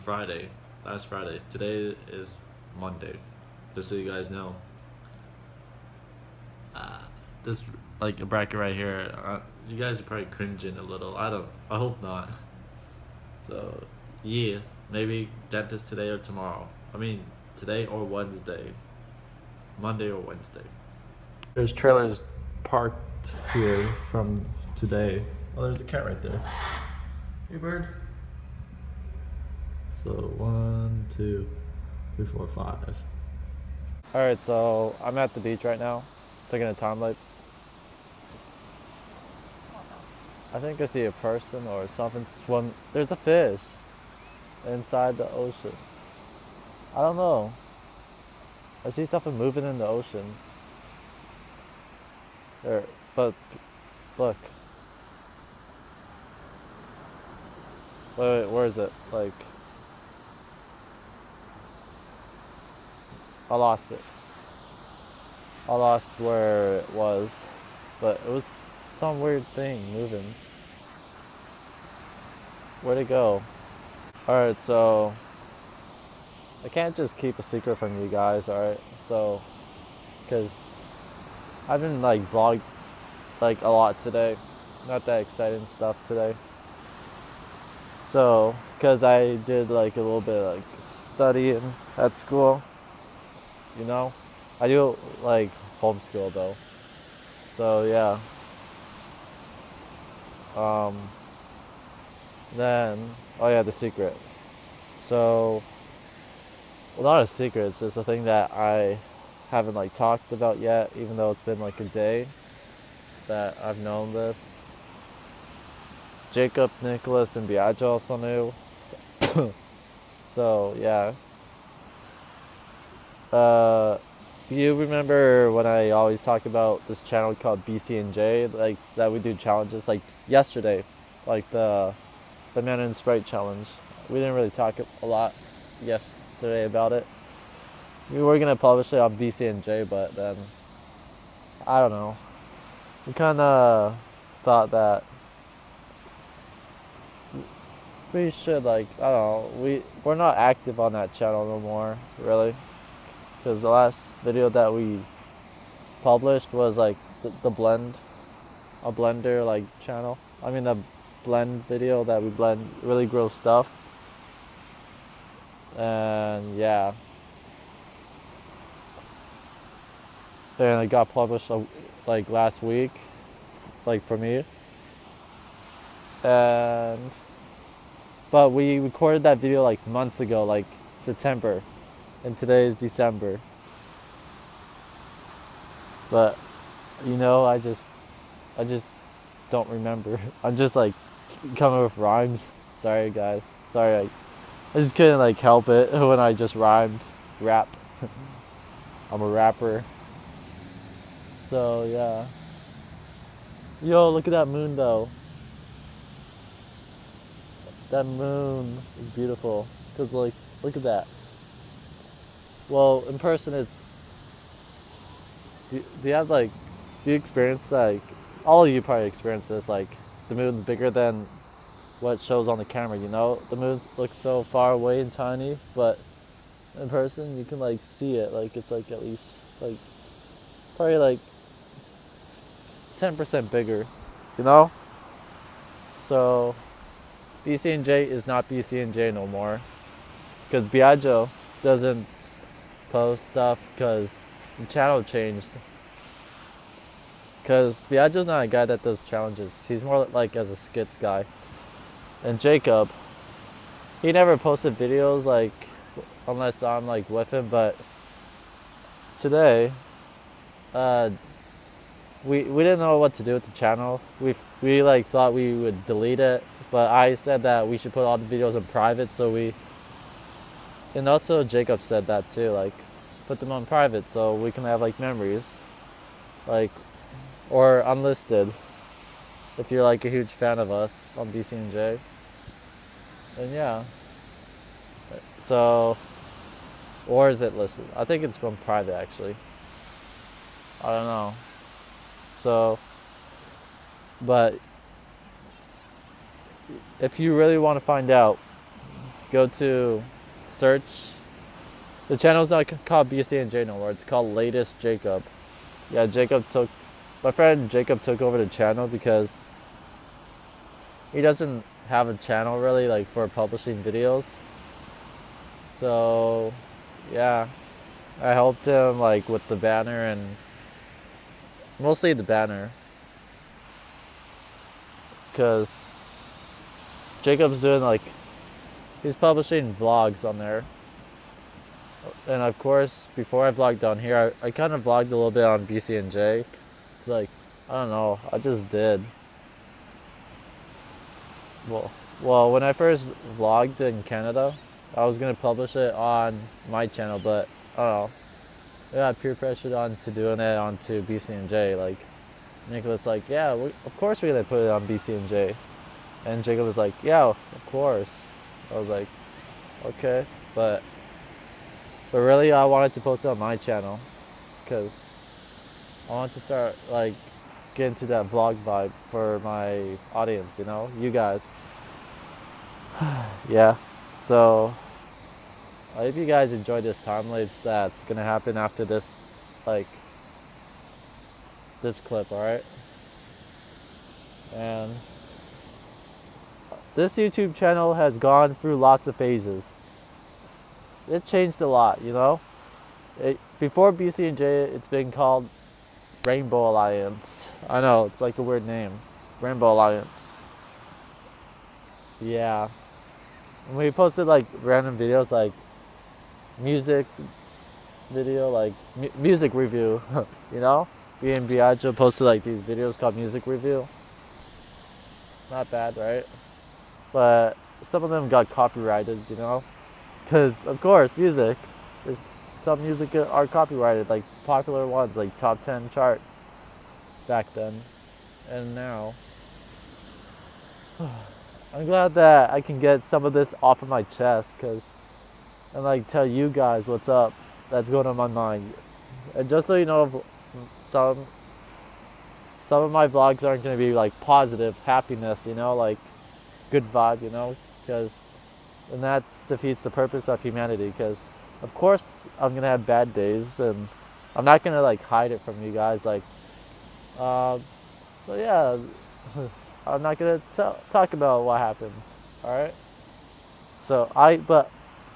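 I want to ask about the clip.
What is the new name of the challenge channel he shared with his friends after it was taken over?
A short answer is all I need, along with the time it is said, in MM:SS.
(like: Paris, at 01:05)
Latest Jacob, at 05:04.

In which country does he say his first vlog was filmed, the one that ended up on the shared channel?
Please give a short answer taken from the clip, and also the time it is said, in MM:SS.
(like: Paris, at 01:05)
Canada, at 05:44.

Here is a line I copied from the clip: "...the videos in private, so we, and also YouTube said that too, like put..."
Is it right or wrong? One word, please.
wrong.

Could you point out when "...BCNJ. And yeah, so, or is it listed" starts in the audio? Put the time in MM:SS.
04:41.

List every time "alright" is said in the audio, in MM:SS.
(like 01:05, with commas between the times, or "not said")
01:14, 01:18, 06:22.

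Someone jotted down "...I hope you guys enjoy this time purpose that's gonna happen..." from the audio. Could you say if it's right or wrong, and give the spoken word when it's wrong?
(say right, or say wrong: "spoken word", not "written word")
wrong: "lapse", not "purpose".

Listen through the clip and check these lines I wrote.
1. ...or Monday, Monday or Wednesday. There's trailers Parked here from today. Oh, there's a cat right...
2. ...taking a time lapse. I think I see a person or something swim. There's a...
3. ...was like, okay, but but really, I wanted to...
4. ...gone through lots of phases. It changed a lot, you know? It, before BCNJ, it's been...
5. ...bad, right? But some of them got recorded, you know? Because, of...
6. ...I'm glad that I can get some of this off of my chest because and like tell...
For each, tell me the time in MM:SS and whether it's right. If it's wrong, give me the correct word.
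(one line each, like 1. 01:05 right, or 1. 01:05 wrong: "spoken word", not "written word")
1. 00:17 wrong: "Wednesday", not "Monday"
2. 00:36 right
3. 05:58 right
4. 06:28 right
5. 06:55 wrong: "copyrighted", not "recorded"
6. 07:11 right.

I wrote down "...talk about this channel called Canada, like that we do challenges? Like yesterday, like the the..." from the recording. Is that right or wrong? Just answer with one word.
wrong.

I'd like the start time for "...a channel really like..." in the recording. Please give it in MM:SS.
05:12.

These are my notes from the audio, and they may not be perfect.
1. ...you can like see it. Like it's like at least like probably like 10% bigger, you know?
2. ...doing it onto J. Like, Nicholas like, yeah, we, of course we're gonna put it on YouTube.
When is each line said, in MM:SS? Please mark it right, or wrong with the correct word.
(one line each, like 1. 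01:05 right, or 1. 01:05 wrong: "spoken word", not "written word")
1. 03:47 right
2. 05:50 wrong: "BCNJ", not "YouTube".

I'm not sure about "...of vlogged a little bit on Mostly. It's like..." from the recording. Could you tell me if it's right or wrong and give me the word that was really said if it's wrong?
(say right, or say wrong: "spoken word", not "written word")
wrong: "BCNJ", not "Mostly".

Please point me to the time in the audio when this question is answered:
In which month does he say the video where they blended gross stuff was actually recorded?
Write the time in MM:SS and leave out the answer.
03:00.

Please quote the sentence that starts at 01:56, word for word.
Jacob, Nicholas, and Biagio also knew.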